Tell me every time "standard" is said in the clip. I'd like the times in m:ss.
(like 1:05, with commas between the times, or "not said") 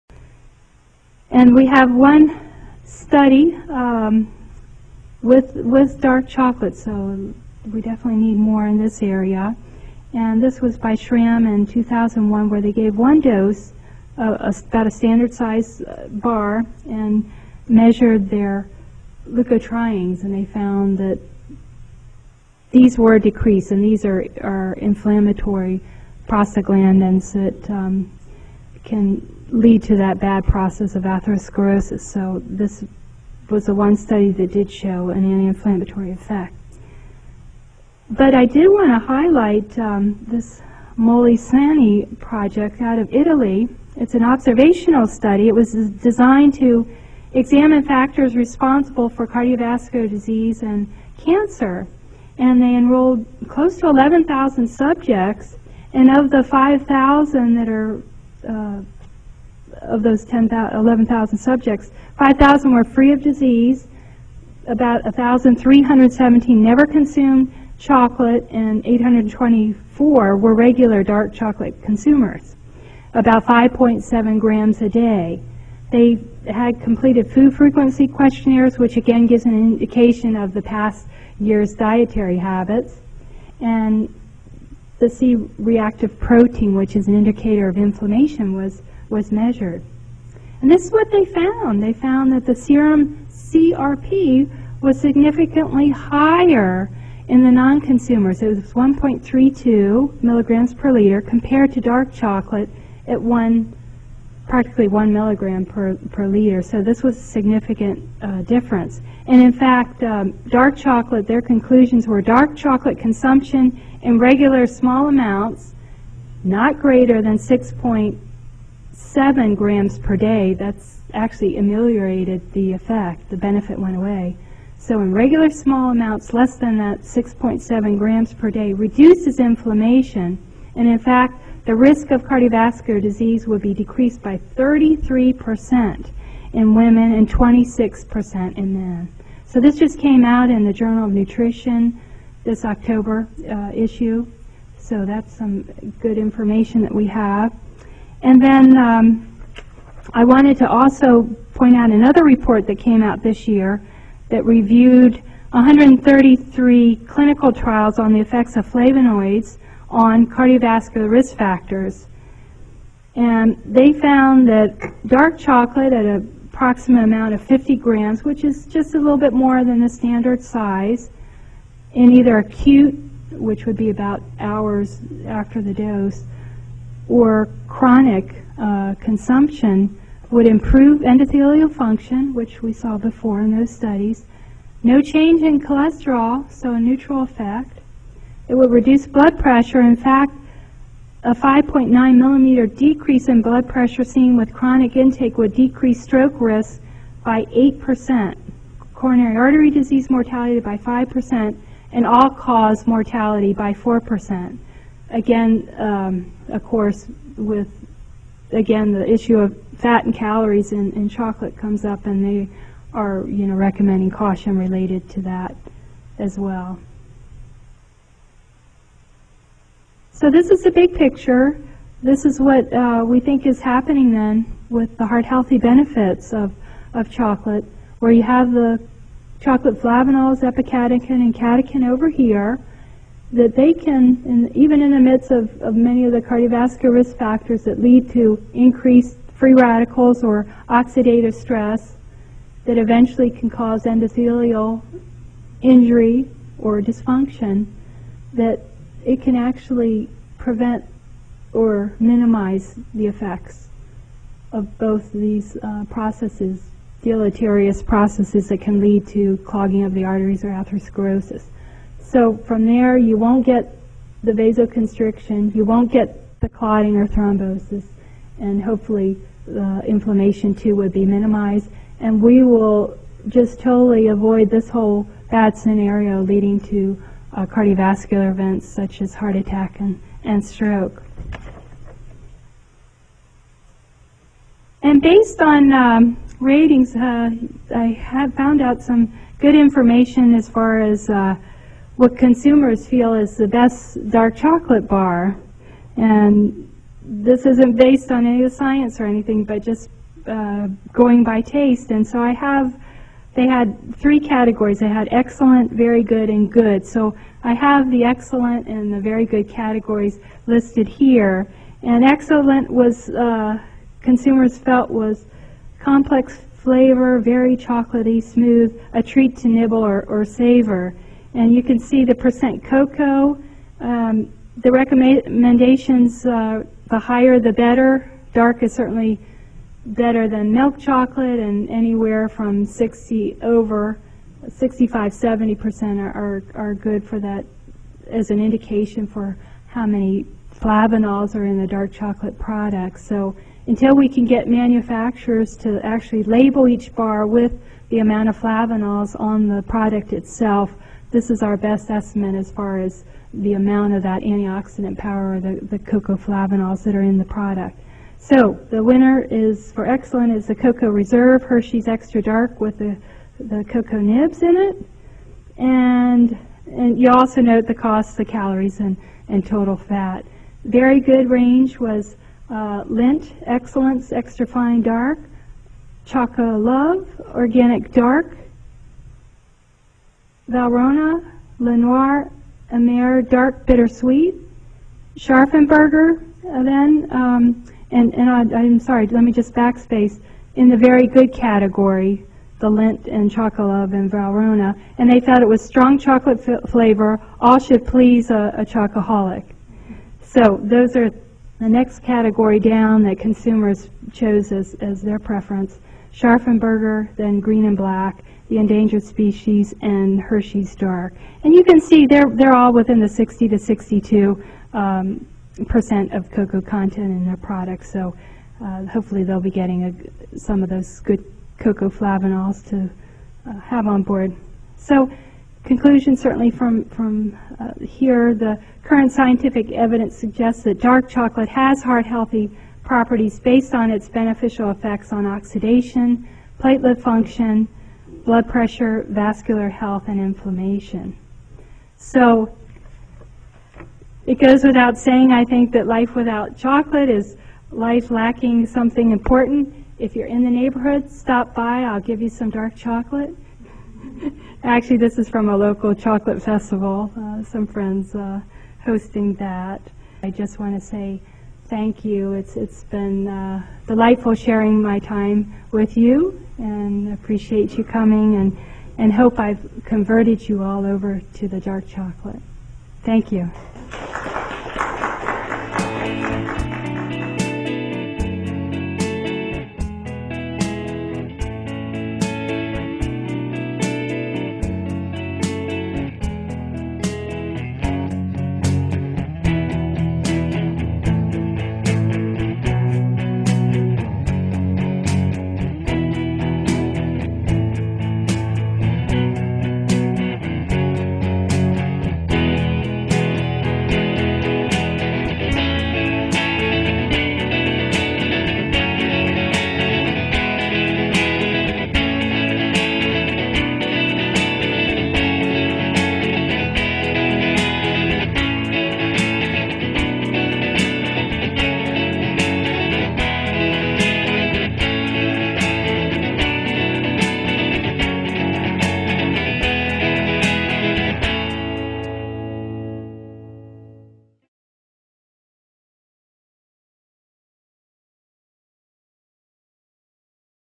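0:14, 2:49.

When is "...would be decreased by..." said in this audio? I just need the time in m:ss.
2:13.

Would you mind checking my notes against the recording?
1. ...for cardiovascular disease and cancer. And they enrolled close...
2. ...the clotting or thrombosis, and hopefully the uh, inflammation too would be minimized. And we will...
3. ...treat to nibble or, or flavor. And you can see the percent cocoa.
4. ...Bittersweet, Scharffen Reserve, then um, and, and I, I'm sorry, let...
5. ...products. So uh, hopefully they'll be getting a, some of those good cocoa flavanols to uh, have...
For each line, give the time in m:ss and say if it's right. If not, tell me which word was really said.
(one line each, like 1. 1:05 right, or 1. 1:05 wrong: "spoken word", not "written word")
1. 0:49 right
2. 4:26 right
3. 5:19 wrong: "savor", not "flavor"
4. 6:23 wrong: "Berger", not "Reserve"
5. 6:57 right.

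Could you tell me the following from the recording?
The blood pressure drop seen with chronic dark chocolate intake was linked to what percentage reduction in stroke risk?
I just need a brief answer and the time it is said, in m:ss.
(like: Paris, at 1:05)
8%, at 3:17.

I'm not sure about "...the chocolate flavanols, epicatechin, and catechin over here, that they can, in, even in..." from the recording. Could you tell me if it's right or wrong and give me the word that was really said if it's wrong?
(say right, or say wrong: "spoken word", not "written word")
right.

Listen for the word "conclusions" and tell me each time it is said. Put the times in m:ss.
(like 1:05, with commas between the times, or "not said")
1:51, 7:05.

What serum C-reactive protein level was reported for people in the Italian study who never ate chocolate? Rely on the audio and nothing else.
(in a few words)
1.32 milligrams per liter.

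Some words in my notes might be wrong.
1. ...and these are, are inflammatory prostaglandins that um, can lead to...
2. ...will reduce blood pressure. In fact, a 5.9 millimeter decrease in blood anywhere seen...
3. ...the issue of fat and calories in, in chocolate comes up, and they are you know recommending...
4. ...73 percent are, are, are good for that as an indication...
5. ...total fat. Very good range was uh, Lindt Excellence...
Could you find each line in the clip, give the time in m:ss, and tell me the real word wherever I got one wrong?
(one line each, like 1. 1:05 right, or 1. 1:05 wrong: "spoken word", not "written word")
1. 0:23 right
2. 3:08 wrong: "pressure", not "anywhere"
3. 3:28 right
4. 5:35 wrong: "70", not "73"
5. 6:09 right.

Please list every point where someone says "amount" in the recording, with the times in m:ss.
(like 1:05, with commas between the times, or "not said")
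1:55, 2:05, 2:47, 5:47, 5:53.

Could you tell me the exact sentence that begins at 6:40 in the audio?
So those are the next category down that consumers chose as, as their preference.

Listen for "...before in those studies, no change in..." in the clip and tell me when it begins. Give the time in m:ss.
3:02.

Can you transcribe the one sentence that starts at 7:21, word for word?
So it goes without saying, I think, that life without chocolate is life lacking something important.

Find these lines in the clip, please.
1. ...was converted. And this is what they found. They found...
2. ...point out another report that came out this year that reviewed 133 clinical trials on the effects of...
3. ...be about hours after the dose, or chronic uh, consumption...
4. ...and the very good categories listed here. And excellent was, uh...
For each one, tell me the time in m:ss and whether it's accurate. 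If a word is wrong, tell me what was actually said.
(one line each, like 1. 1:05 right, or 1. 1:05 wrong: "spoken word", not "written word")
1. 1:29 wrong: "measured", not "converted"
2. 2:31 right
3. 2:53 right
4. 5:08 right.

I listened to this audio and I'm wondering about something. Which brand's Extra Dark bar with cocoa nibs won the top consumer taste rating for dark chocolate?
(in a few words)
Cocoa Reserve Hershey's.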